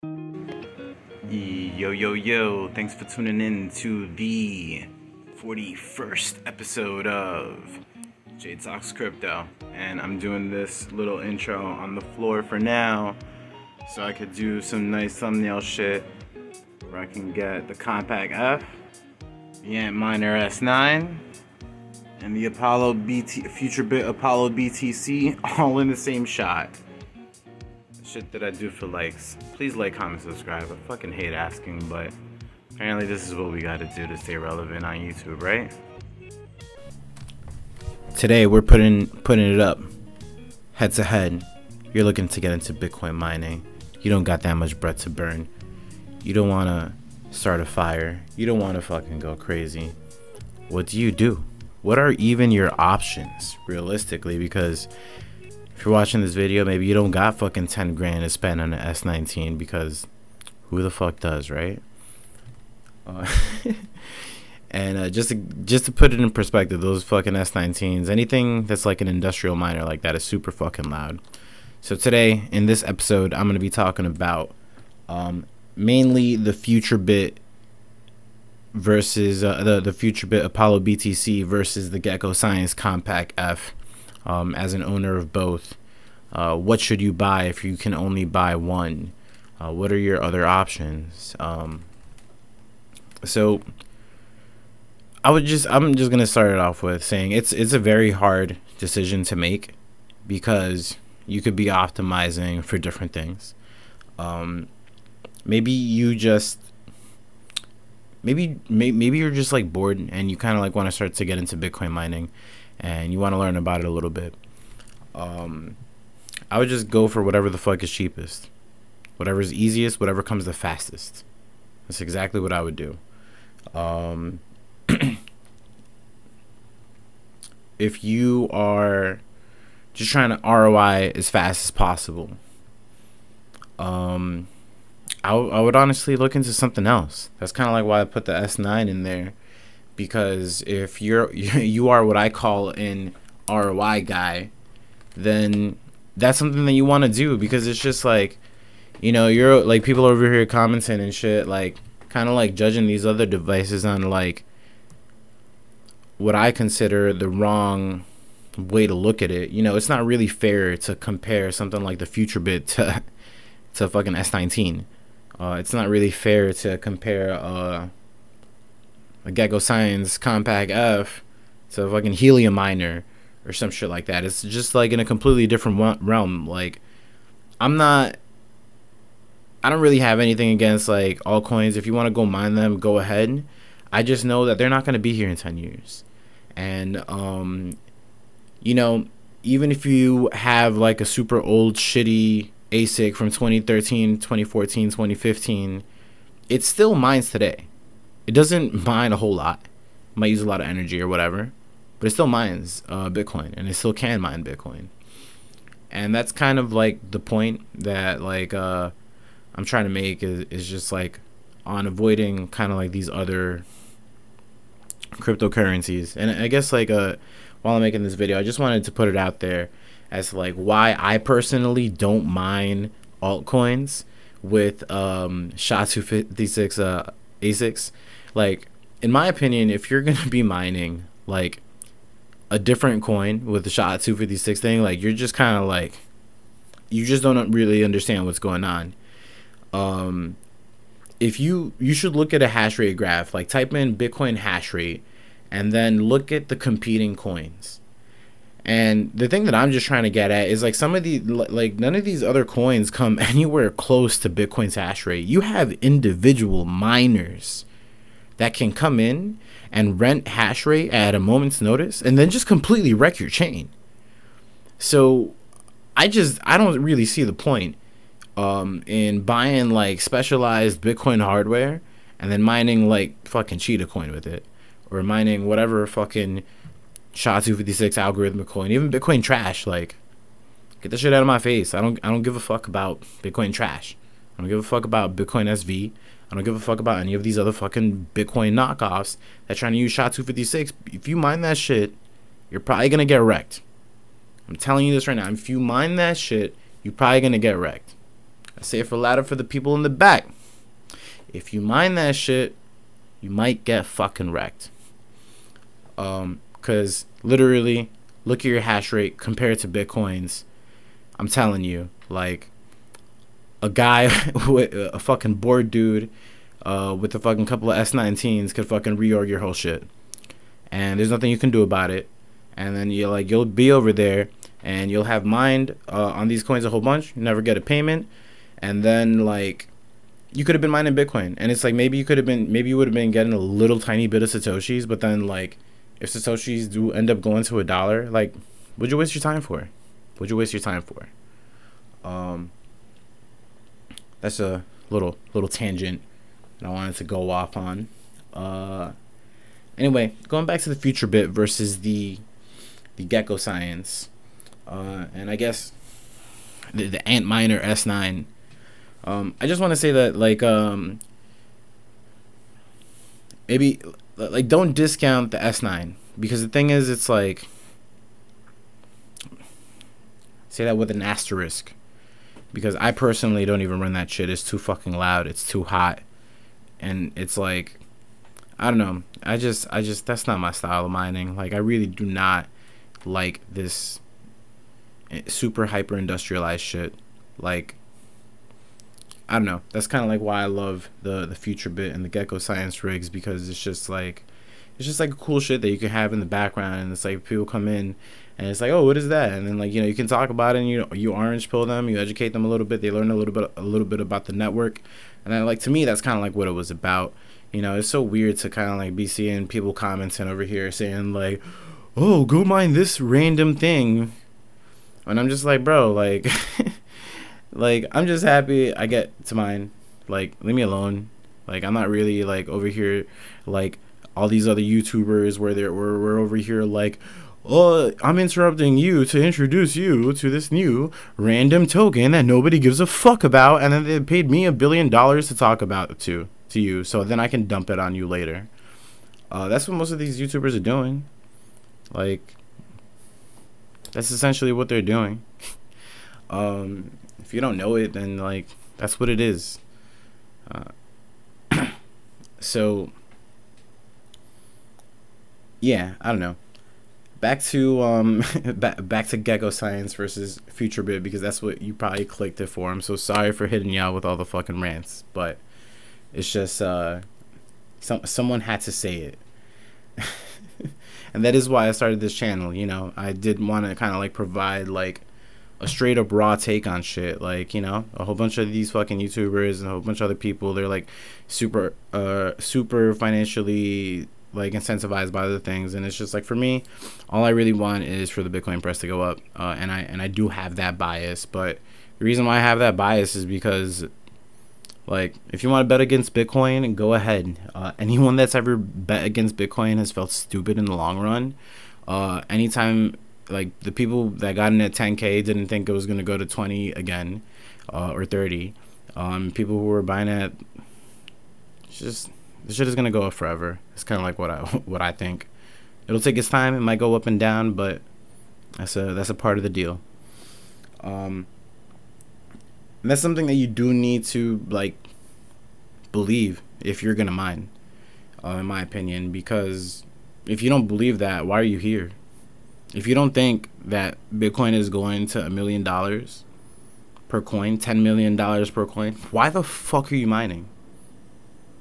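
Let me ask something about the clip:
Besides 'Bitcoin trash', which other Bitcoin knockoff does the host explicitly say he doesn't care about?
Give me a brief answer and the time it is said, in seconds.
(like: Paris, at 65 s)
Bitcoin SV, at 285 s.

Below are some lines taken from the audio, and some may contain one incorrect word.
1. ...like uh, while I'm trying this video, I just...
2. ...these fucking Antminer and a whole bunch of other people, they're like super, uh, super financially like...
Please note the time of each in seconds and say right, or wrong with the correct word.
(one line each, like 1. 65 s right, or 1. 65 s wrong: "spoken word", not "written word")
1. 216 s wrong: "making", not "trying"
2. 478 s wrong: "YouTubers", not "Antminer".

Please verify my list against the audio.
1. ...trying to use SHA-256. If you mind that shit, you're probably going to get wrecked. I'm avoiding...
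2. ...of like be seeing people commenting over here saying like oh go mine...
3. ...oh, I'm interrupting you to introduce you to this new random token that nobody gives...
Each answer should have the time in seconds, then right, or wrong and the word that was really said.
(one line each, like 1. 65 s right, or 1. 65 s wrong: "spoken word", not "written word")
1. 289 s wrong: "telling", not "avoiding"
2. 408 s right
3. 427 s right.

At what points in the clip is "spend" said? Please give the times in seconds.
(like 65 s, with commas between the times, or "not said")
58 s.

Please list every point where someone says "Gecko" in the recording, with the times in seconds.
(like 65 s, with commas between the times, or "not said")
81 s, 169 s.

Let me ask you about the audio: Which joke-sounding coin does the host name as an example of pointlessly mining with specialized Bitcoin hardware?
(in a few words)
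Cheetah coin.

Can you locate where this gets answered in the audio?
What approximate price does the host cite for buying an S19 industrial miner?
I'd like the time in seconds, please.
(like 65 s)
57 s.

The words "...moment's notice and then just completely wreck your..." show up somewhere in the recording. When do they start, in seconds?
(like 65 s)
261 s.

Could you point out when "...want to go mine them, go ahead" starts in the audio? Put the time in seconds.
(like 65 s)
181 s.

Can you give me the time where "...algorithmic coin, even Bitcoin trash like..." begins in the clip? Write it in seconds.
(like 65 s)
277 s.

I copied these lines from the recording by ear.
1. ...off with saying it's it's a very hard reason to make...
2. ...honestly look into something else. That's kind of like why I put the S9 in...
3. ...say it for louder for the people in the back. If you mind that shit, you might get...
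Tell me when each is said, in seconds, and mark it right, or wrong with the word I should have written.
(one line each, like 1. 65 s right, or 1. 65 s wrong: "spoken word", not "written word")
1. 96 s wrong: "decision", not "reason"
2. 135 s right
3. 298 s right.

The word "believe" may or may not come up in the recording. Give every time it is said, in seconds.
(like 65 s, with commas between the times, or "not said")
525 s, 530 s.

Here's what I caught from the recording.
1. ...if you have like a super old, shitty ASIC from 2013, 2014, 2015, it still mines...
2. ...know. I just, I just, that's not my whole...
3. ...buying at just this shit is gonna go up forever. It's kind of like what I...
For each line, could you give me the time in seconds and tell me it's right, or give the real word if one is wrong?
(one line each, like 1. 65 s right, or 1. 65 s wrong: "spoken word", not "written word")
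1. 189 s right
2. 378 s wrong: "style", not "whole"
3. 509 s right.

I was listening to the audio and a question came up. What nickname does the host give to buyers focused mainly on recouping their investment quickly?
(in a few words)
ROI guy.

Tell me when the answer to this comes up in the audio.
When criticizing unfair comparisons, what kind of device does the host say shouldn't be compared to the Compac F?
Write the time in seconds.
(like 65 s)
172 s.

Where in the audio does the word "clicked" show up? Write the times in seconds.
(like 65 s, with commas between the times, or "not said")
462 s.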